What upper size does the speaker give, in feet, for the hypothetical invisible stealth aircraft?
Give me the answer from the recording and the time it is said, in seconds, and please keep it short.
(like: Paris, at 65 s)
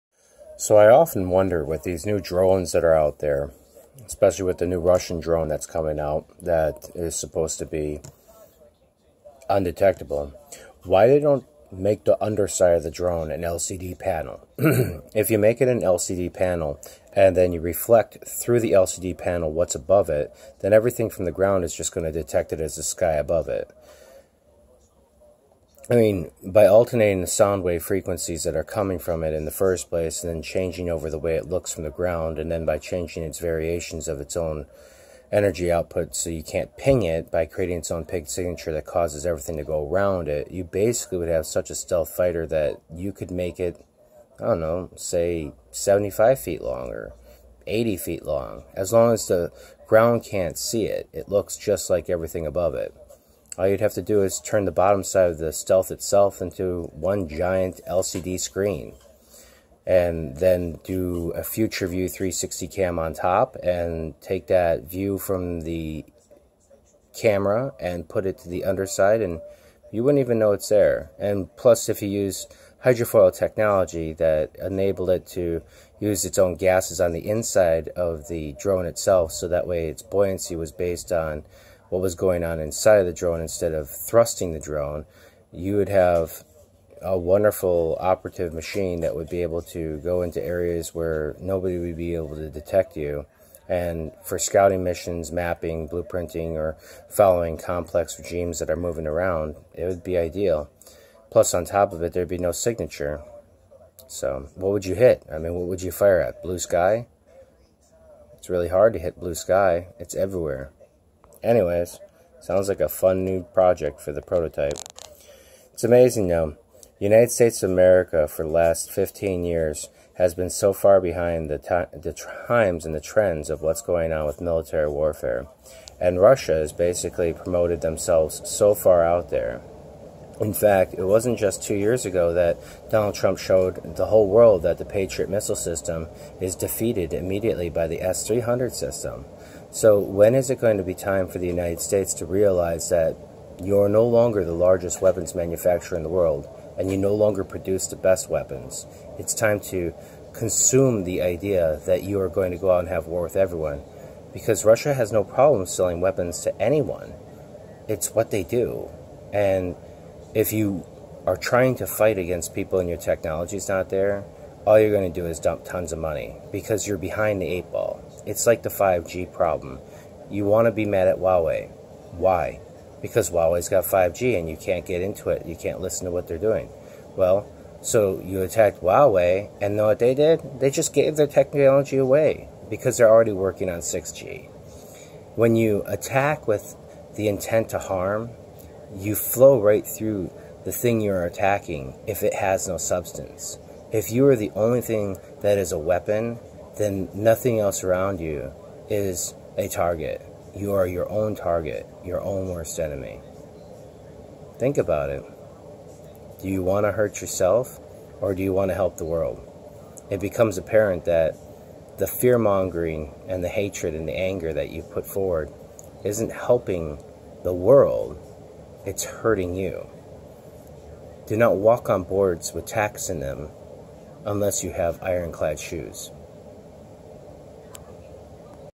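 80 feet, at 47 s.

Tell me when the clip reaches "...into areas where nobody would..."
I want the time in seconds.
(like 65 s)
90 s.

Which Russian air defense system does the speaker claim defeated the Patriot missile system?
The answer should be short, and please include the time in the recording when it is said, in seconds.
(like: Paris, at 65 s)
S-300, at 138 s.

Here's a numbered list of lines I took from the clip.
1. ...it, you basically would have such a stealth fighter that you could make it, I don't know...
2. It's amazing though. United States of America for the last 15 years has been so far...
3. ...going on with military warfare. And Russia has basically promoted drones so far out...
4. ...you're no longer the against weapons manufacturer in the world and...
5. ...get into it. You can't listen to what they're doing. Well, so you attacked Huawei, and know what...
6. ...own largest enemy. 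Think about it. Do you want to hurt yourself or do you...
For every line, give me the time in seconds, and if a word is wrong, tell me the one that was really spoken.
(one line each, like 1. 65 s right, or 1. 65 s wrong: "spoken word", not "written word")
1. 40 s right
2. 115 s right
3. 123 s wrong: "themselves", not "drones"
4. 143 s wrong: "largest", not "against"
5. 174 s right
6. 202 s wrong: "worst", not "largest".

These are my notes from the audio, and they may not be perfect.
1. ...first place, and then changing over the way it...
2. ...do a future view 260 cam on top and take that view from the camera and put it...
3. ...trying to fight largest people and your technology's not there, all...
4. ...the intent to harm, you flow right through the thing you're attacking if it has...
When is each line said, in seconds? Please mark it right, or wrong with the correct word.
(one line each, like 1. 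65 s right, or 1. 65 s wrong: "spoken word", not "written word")
1. 29 s right
2. 60 s wrong: "360", not "260"
3. 161 s wrong: "against", not "largest"
4. 187 s right.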